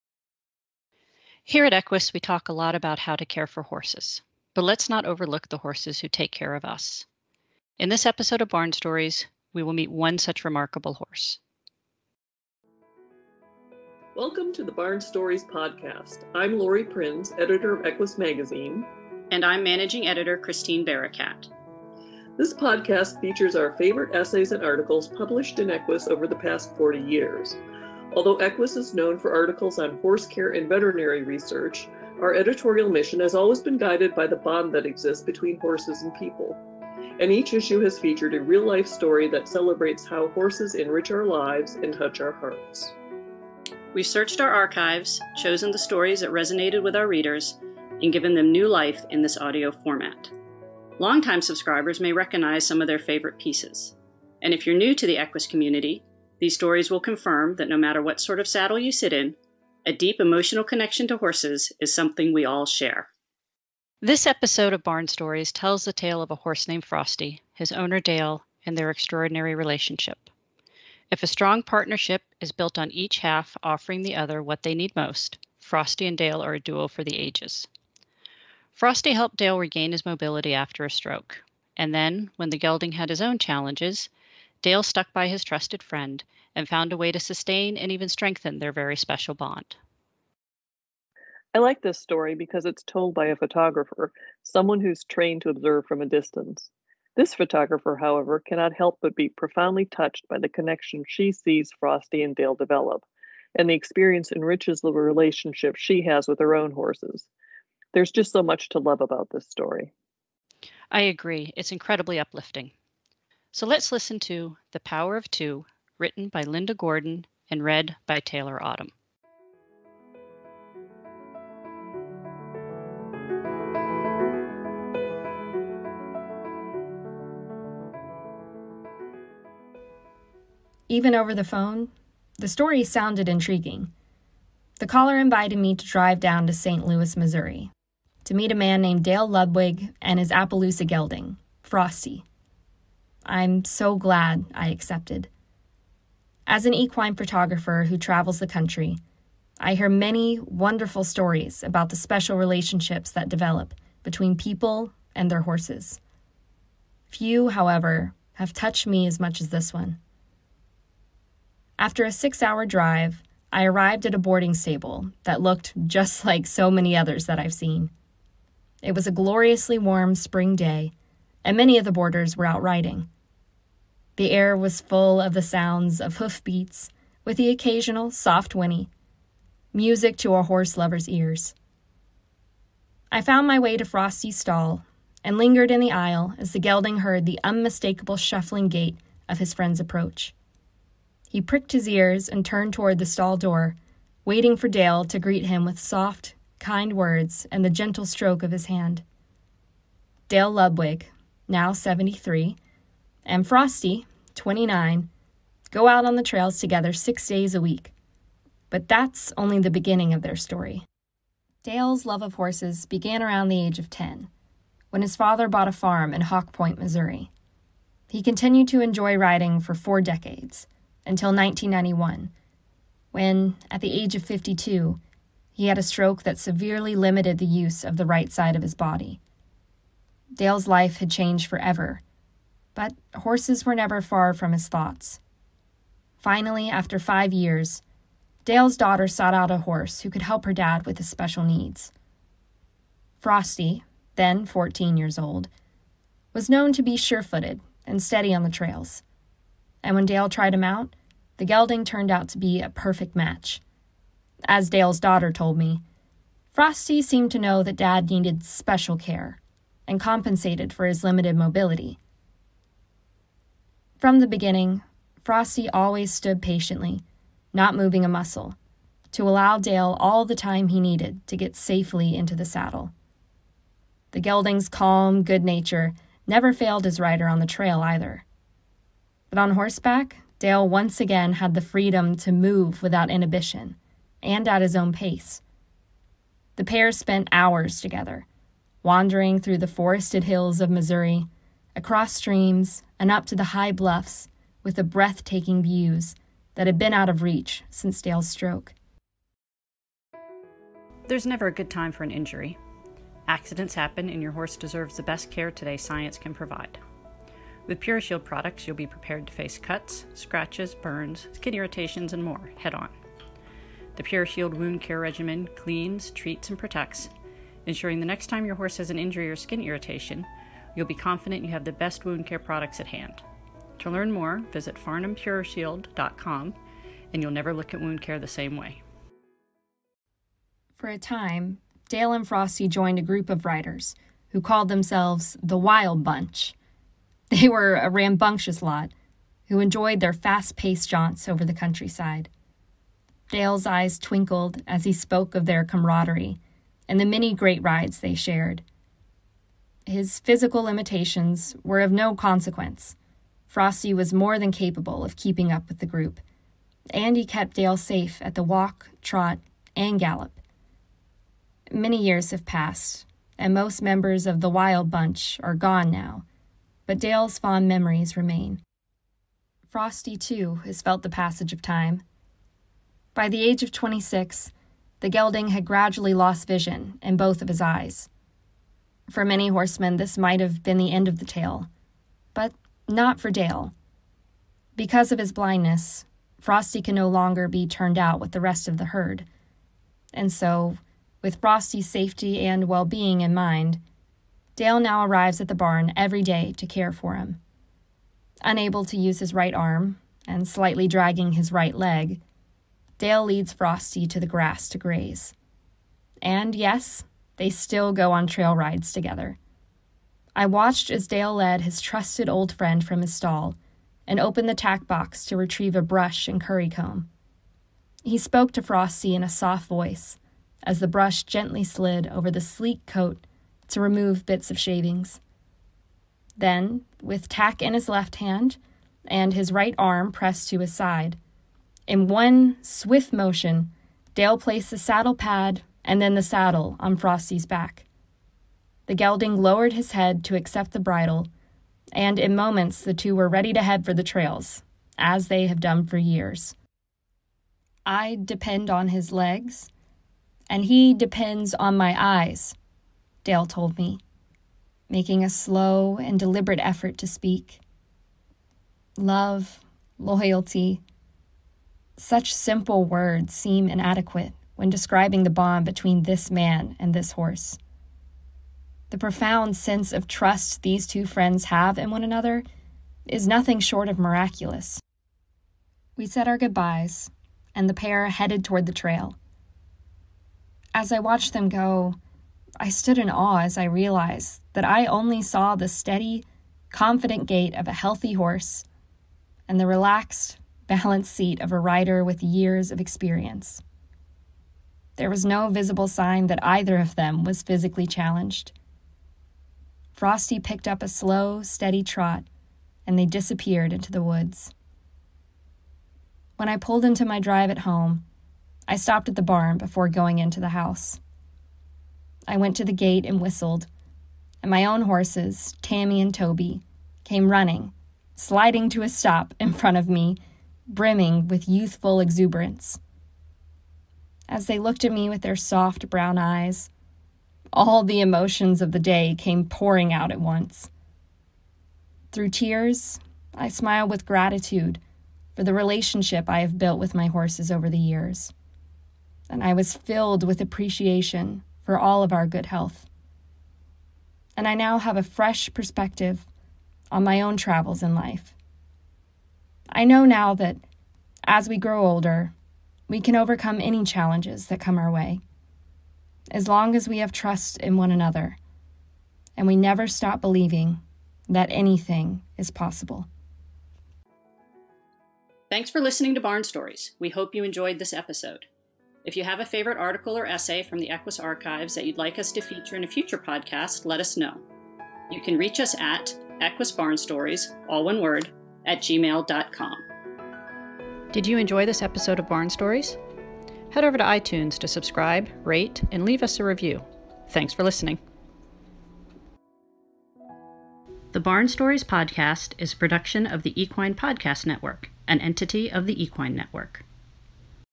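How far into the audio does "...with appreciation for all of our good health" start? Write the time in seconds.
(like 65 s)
540 s.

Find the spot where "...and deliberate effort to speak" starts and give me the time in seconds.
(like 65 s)
455 s.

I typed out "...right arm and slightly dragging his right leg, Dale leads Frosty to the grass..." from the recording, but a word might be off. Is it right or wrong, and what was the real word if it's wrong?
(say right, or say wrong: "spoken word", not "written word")
right.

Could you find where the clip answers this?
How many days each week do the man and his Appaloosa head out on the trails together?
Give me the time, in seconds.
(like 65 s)
206 s.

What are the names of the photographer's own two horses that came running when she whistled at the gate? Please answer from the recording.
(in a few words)
Tammy and Toby.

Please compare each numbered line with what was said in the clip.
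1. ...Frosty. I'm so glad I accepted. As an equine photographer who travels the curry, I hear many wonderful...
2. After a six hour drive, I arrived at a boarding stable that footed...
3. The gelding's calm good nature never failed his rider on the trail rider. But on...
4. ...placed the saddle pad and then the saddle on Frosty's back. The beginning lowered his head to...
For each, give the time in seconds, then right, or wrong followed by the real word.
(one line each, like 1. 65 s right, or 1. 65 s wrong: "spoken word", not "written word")
1. 141 s wrong: "country", not "curry"
2. 161 s wrong: "looked", not "footed"
3. 274 s wrong: "either", not "rider"
4. 434 s wrong: "gelding", not "beginning".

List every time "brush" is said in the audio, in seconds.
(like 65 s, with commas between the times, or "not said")
415 s, 420 s.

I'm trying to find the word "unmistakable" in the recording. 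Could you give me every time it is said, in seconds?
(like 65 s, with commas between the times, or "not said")
187 s.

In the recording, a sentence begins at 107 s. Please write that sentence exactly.
There's just so much to love about this story.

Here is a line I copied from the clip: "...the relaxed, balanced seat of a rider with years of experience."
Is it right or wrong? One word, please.
right.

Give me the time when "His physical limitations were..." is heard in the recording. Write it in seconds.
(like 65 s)
349 s.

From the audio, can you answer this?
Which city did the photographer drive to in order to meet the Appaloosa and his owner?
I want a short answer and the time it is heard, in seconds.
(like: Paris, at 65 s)
St. Louis, Missouri, at 136 s.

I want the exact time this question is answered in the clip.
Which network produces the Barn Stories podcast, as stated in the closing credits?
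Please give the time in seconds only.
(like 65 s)
593 s.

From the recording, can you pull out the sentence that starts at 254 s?
As Dale's daughter told me, Frosty seemed to know that Dad needed special care, and compensated for his limited mobility.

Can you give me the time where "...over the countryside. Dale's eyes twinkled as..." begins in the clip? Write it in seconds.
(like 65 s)
341 s.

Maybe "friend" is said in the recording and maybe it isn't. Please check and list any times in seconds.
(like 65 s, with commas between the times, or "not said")
85 s, 189 s, 412 s, 471 s.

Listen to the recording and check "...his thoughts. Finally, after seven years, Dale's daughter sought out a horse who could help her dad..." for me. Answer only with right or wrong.
wrong.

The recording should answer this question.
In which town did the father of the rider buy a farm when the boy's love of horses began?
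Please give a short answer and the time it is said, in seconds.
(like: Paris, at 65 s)
Hawk Point, Missouri, at 216 s.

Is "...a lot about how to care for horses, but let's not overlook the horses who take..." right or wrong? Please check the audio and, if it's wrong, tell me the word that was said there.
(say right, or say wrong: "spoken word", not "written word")
right.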